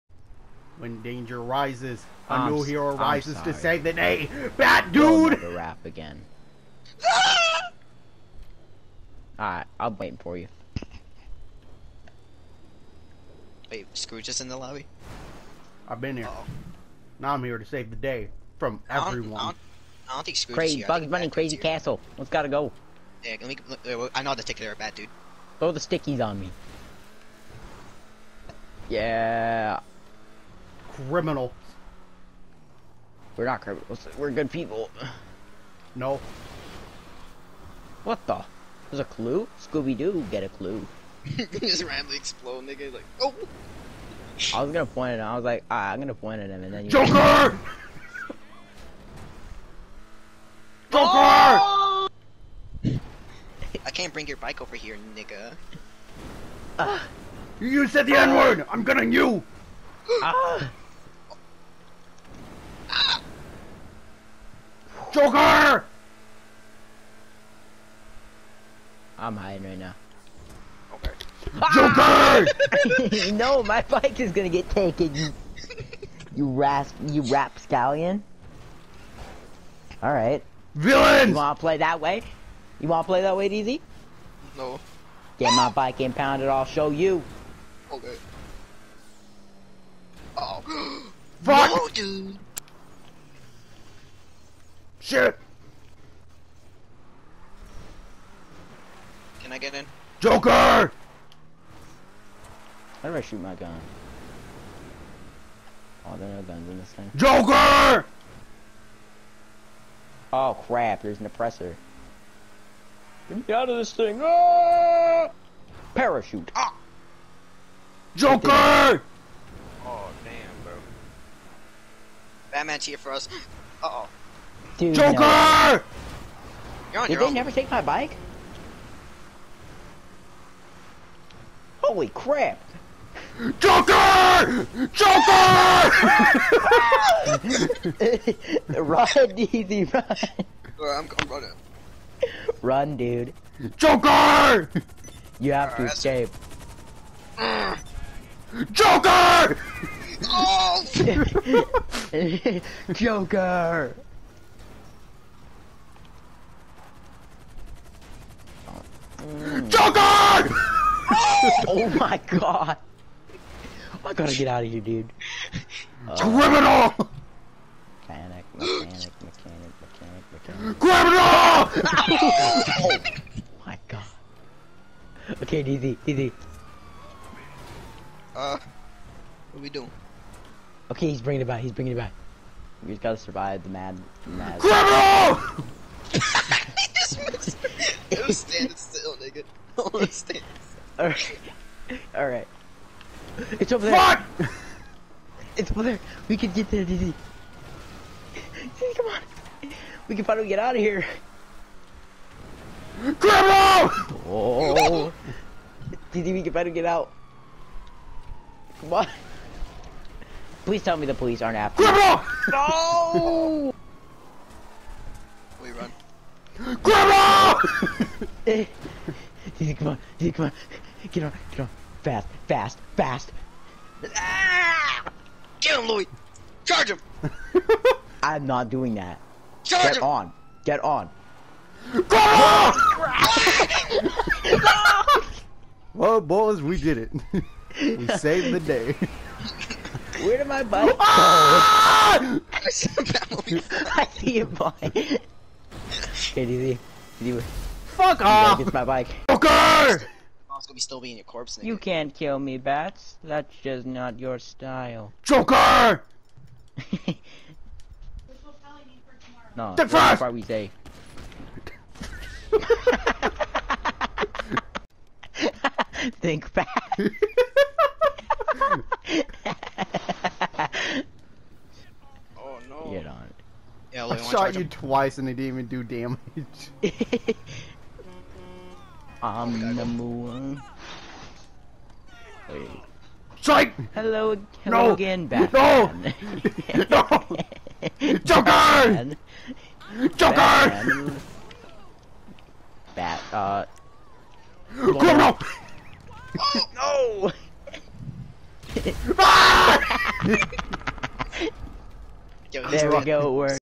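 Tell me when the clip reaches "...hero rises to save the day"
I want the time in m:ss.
0:02.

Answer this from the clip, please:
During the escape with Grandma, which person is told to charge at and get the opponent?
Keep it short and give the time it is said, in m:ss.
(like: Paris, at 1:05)
Louis, at 3:45.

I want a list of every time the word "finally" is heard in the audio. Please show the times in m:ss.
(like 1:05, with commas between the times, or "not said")
3:20, 3:26.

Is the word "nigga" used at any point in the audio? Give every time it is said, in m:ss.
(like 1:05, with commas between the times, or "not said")
0:42, 0:55, 3:09, 4:11.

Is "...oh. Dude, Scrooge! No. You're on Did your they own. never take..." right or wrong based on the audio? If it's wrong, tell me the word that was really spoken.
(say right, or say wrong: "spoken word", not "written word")
wrong: "Joker", not "Scrooge".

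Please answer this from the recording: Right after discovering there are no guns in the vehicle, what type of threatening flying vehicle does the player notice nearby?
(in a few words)
Oppressor.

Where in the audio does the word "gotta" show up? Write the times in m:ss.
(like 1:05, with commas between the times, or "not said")
0:22, 2:44, 3:03.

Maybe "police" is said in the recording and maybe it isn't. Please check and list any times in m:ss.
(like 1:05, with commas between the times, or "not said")
3:31.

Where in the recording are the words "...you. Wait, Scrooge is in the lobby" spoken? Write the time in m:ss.
0:10.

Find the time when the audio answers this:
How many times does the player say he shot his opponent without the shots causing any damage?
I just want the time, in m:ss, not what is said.
4:34.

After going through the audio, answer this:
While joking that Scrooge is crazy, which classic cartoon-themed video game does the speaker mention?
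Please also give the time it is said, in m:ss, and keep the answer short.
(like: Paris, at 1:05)
Bugs Bunny Crazy Castle, at 0:20.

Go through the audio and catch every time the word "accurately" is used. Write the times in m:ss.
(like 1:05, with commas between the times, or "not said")
not said.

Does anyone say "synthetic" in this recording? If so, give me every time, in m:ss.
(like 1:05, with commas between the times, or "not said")
not said.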